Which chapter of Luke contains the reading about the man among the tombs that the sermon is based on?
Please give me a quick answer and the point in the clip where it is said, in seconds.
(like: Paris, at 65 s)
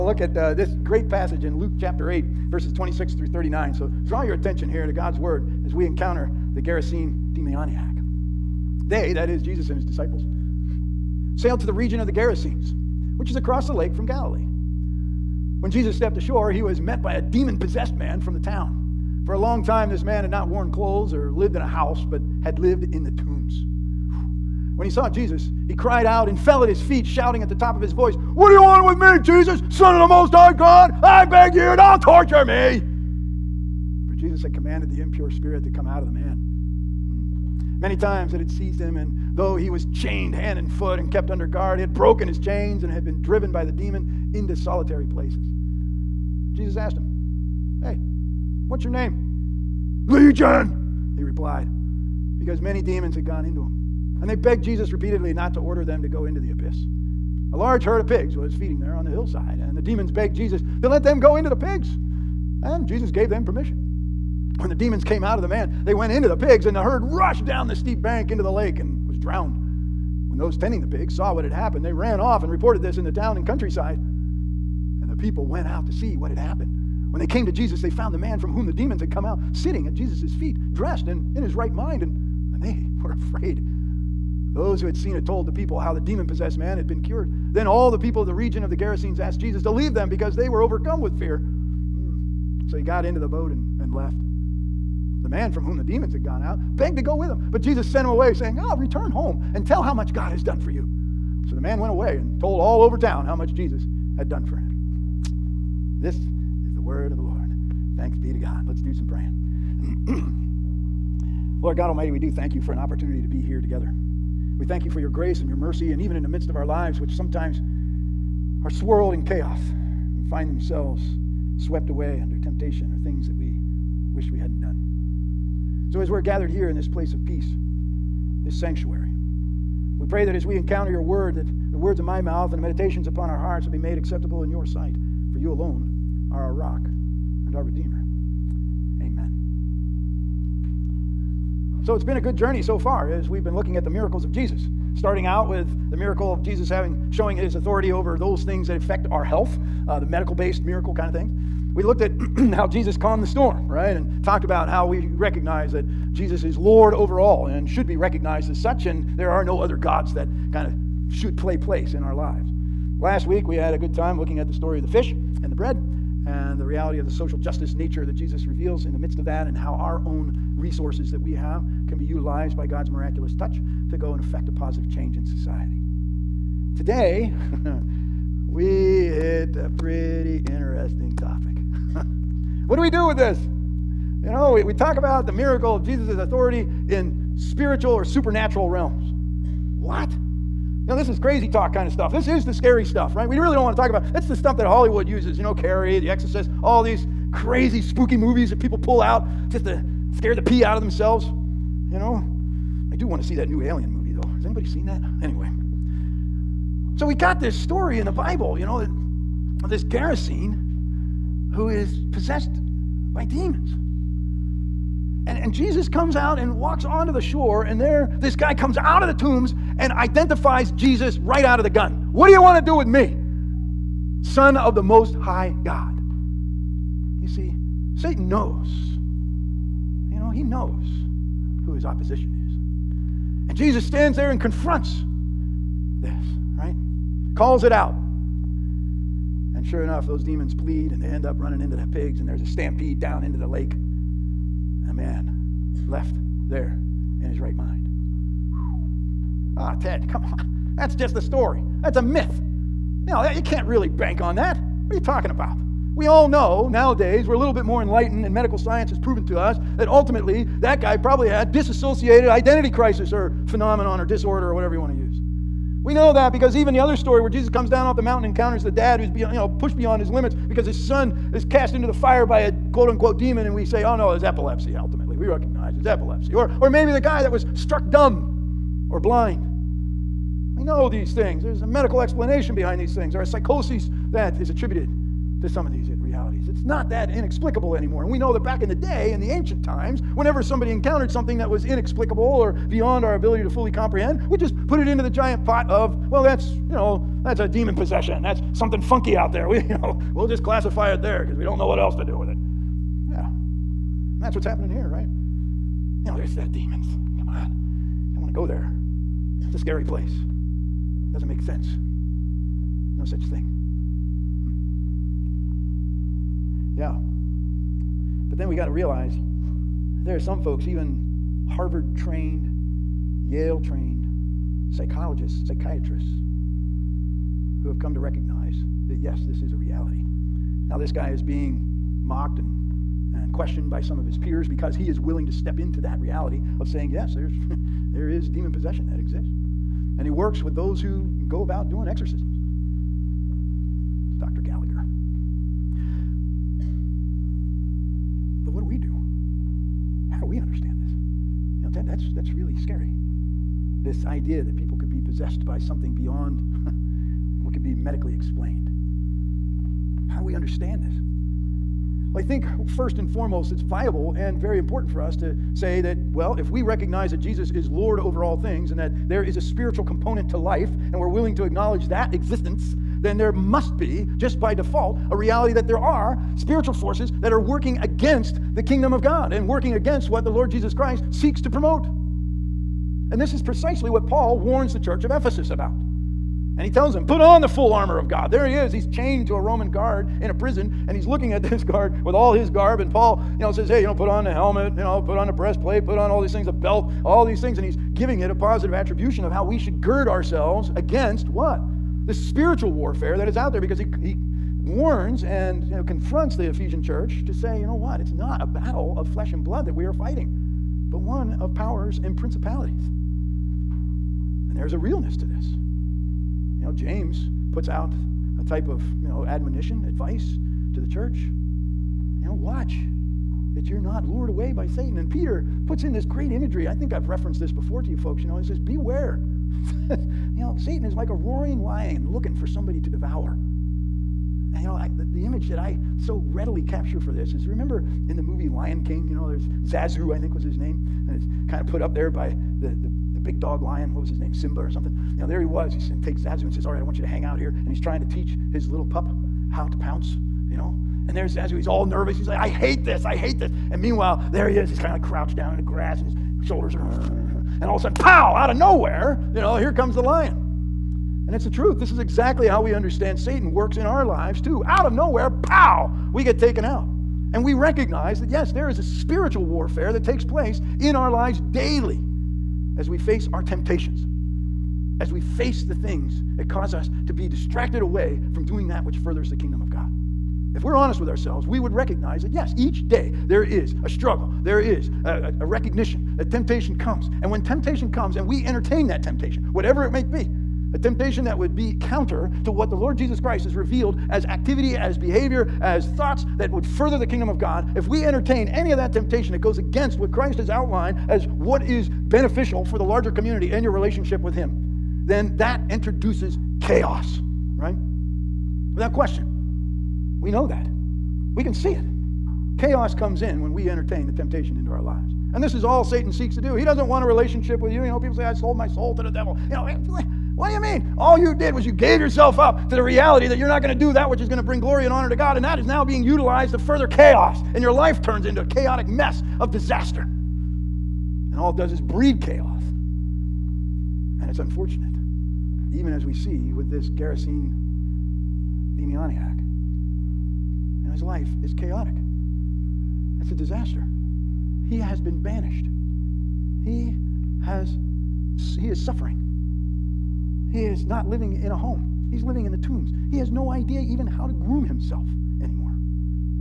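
Chapter 8, at 1 s.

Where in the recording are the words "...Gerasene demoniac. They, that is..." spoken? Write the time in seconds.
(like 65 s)
6 s.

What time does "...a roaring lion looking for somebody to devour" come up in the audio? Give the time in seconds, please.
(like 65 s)
431 s.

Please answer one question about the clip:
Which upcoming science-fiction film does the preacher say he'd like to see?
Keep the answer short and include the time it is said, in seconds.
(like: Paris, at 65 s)
Alien, at 203 s.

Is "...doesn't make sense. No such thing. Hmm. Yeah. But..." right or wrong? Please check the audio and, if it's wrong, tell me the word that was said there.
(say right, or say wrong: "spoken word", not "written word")
right.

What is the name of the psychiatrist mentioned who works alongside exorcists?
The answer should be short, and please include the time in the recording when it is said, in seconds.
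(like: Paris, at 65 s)
Dr. Gallagher, at 344 s.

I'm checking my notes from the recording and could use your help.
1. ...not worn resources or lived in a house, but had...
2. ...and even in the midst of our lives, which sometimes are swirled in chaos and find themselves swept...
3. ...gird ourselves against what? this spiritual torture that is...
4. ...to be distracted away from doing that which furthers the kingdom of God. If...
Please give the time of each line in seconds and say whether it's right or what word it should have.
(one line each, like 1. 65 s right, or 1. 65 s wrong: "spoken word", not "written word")
1. 20 s wrong: "clothes", not "resources"
2. 115 s right
3. 399 s wrong: "warfare", not "torture"
4. 477 s right.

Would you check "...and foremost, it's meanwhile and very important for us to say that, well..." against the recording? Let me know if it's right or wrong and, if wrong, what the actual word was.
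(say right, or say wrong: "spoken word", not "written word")
wrong: "viable", not "meanwhile".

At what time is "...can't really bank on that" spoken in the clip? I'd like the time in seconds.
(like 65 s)
253 s.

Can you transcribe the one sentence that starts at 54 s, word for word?
And they begged Jesus repeatedly not to order them to go into the abyss.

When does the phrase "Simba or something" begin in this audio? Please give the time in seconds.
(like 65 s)
444 s.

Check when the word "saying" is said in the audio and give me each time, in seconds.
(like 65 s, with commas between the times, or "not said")
98 s, 336 s.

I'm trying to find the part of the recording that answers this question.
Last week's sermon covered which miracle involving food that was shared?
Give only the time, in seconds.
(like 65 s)
164 s.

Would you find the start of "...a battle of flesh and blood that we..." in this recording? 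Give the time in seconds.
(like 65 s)
408 s.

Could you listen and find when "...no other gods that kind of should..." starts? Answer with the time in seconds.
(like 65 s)
159 s.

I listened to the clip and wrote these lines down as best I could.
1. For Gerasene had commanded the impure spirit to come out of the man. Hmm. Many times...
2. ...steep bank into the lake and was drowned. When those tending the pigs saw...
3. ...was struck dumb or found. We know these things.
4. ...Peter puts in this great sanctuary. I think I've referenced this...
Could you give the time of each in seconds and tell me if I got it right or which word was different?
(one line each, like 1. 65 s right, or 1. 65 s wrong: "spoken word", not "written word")
1. 34 s wrong: "Jesus", not "Gerasene"
2. 67 s right
3. 277 s wrong: "blind", not "found"
4. 425 s wrong: "imagery", not "sanctuary".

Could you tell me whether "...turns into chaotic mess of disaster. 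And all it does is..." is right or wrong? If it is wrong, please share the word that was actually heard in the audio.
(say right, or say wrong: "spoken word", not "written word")
right.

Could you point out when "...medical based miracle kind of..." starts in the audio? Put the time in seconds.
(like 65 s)
150 s.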